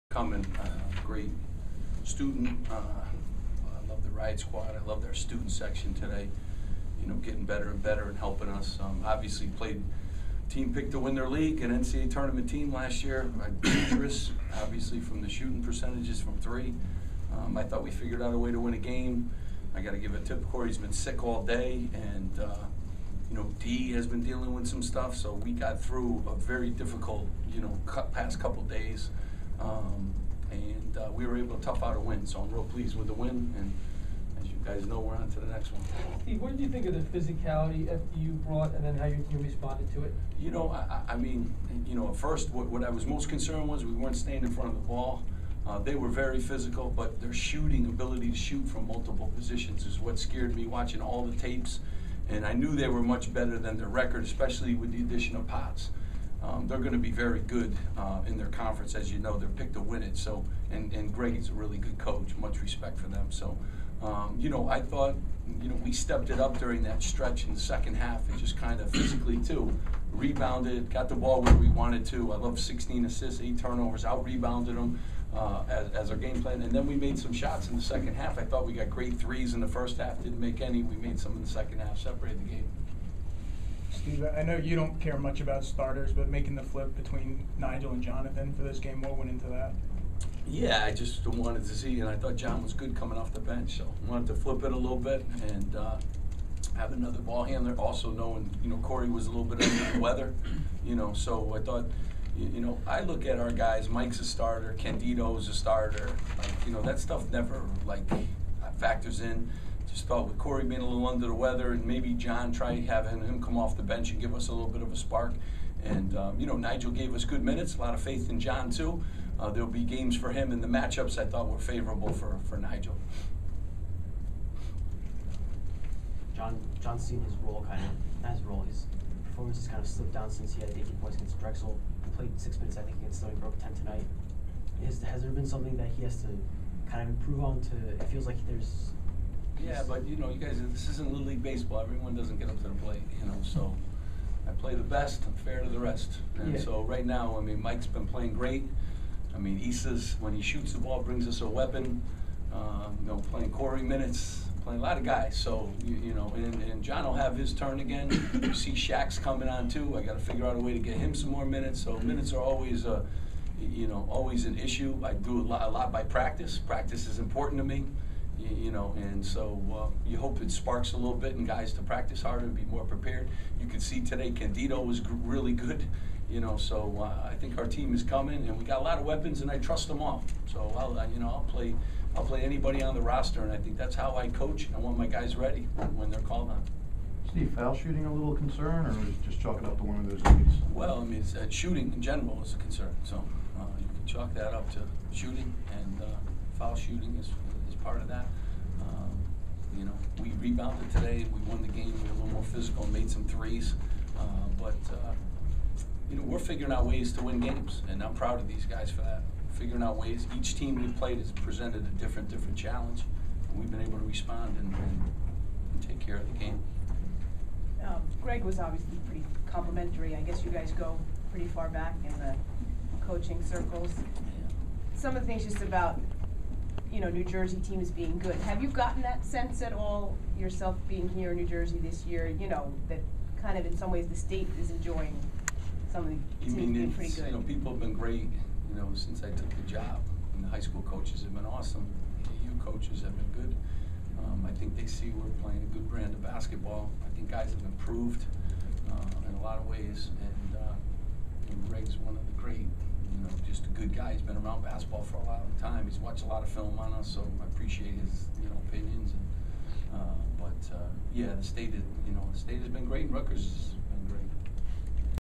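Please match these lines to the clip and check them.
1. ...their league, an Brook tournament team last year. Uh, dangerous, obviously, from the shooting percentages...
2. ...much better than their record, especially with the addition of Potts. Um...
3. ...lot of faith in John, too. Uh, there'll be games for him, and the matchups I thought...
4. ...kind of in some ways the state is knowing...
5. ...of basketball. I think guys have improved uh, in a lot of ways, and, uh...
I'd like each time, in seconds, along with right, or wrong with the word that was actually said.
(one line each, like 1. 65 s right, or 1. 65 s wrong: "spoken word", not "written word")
1. 11 s wrong: "NCAA", not "Brook"
2. 53 s right
3. 117 s right
4. 233 s wrong: "enjoying", not "knowing"
5. 246 s right.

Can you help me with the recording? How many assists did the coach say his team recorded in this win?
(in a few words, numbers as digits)
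16.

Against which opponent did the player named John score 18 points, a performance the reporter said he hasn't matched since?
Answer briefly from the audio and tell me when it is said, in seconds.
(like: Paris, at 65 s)
Drexel, at 131 s.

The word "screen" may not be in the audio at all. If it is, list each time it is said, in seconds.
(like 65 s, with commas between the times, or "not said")
not said.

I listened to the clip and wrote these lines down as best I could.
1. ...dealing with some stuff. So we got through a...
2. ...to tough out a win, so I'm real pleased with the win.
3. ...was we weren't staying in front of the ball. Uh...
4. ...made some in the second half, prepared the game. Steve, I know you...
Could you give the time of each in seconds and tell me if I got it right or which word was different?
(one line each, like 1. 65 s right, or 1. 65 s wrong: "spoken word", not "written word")
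1. 24 s right
2. 31 s right
3. 43 s right
4. 80 s wrong: "separated", not "prepared".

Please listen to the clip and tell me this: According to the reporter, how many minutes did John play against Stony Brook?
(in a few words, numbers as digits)
6.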